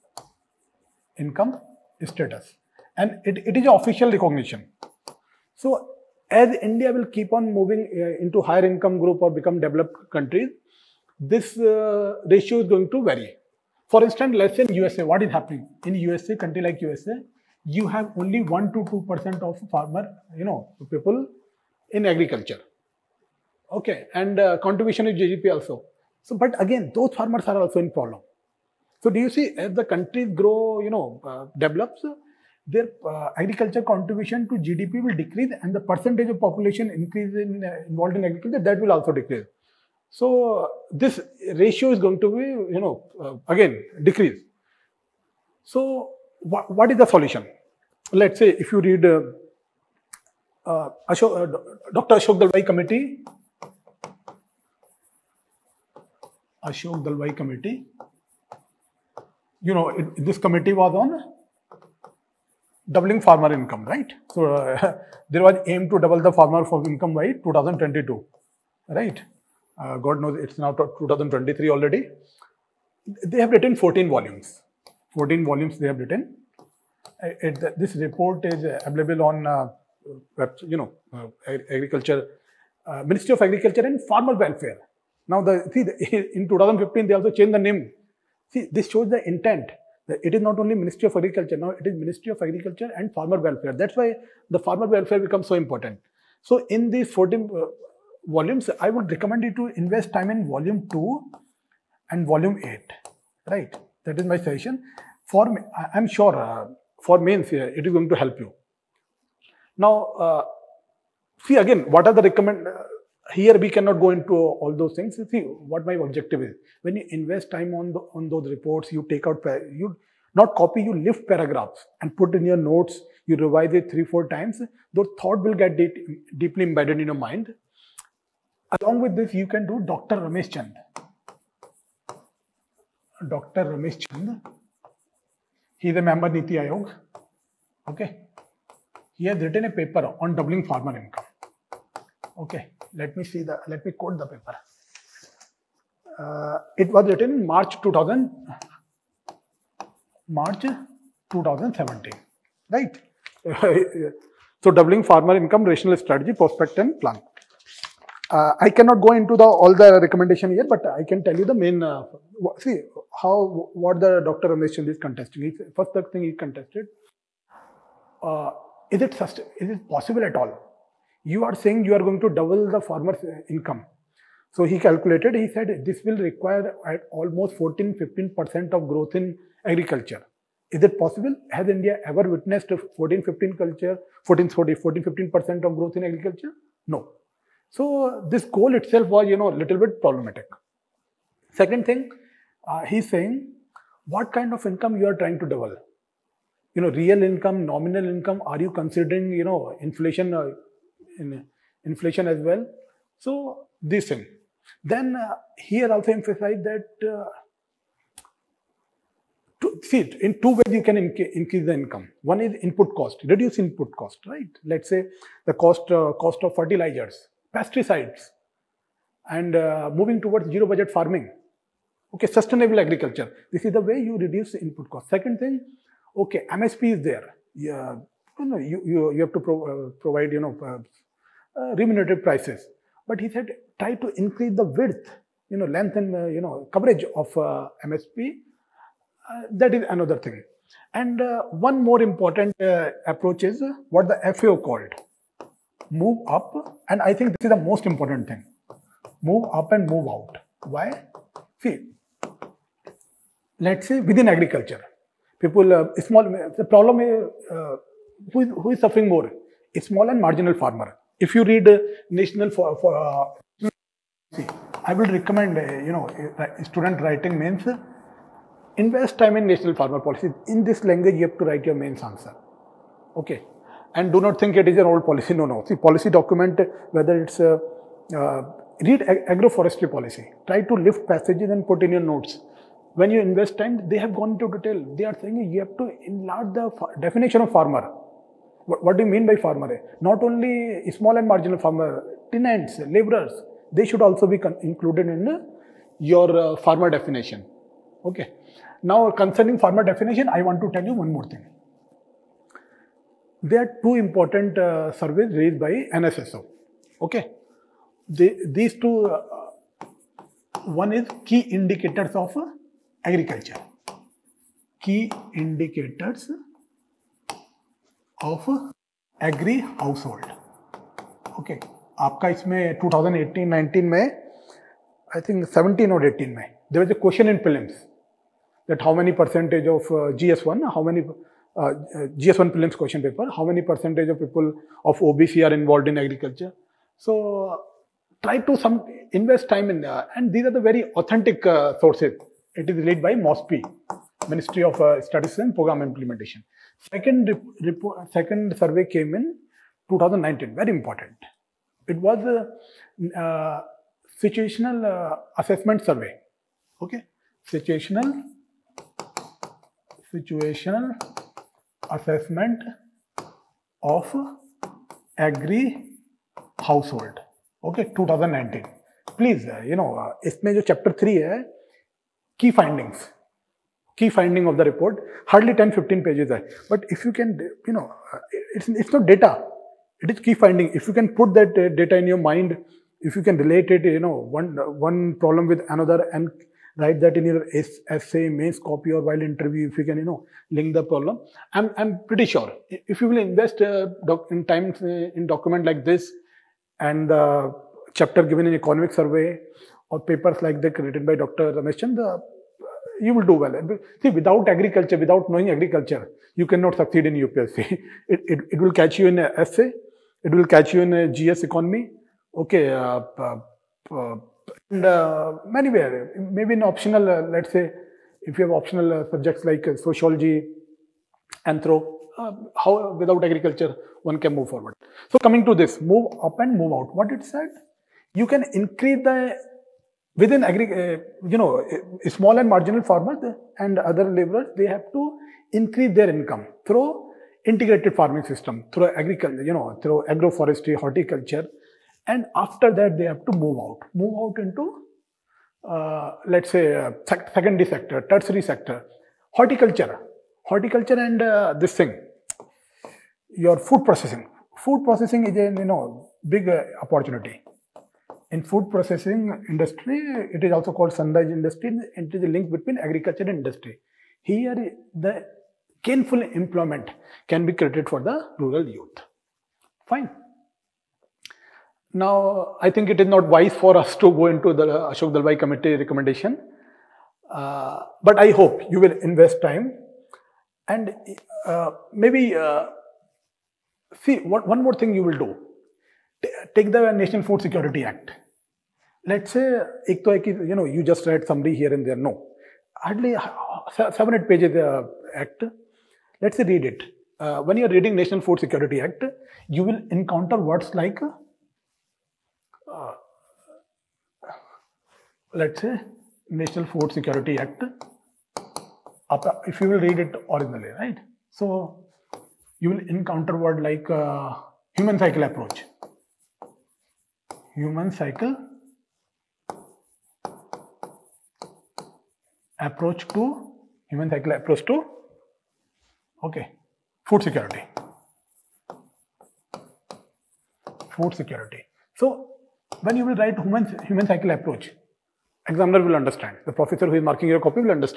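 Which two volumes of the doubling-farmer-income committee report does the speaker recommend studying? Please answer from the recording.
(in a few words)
Volume 2 and volume 8.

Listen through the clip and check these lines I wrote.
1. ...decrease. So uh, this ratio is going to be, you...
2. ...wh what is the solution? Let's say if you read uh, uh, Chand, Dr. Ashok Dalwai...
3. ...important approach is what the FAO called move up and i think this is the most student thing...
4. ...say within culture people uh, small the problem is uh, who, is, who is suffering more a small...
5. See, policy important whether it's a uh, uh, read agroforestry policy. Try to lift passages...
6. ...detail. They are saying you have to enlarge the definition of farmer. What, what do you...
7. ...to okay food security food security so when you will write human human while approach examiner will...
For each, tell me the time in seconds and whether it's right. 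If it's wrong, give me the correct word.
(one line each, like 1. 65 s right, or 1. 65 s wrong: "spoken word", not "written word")
1. 39 s right
2. 46 s wrong: "Ashok", not "Chand"
3. 242 s wrong: "important", not "student"
4. 253 s wrong: "agriculture", not "culture"
5. 275 s wrong: "document", not "important"
6. 284 s right
7. 524 s wrong: "cycle", not "while".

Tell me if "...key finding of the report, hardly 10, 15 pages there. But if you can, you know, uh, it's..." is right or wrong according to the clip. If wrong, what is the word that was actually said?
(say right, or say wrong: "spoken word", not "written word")
right.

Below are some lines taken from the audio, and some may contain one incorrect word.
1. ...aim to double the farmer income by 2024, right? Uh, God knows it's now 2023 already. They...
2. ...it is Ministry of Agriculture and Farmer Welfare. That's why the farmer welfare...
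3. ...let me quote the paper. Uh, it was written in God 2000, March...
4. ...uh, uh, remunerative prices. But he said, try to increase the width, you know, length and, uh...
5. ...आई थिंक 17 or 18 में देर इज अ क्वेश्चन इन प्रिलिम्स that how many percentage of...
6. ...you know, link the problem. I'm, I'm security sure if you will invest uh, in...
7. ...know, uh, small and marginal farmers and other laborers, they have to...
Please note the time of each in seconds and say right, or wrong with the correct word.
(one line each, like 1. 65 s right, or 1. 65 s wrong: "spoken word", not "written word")
1. 65 s wrong: "2022", not "2024"
2. 91 s right
3. 143 s wrong: "March", not "God"
4. 230 s right
5. 324 s right
6. 389 s wrong: "pretty", not "security"
7. 431 s right.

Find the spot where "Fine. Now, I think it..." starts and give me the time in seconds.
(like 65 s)
469 s.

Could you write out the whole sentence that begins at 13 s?
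For instance, let's say in USA, what is happening?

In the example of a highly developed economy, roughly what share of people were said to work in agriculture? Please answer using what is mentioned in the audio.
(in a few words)
1 to 2%.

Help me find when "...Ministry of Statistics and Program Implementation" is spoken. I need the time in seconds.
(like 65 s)
344 s.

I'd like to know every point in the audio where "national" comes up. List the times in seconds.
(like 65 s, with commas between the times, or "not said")
262 s, 269 s, 486 s, 497 s, 506 s.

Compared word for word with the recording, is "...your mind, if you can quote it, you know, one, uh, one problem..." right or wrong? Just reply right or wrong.
wrong.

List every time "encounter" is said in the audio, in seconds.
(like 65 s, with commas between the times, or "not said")
499 s, 512 s.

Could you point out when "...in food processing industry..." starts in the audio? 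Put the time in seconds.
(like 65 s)
458 s.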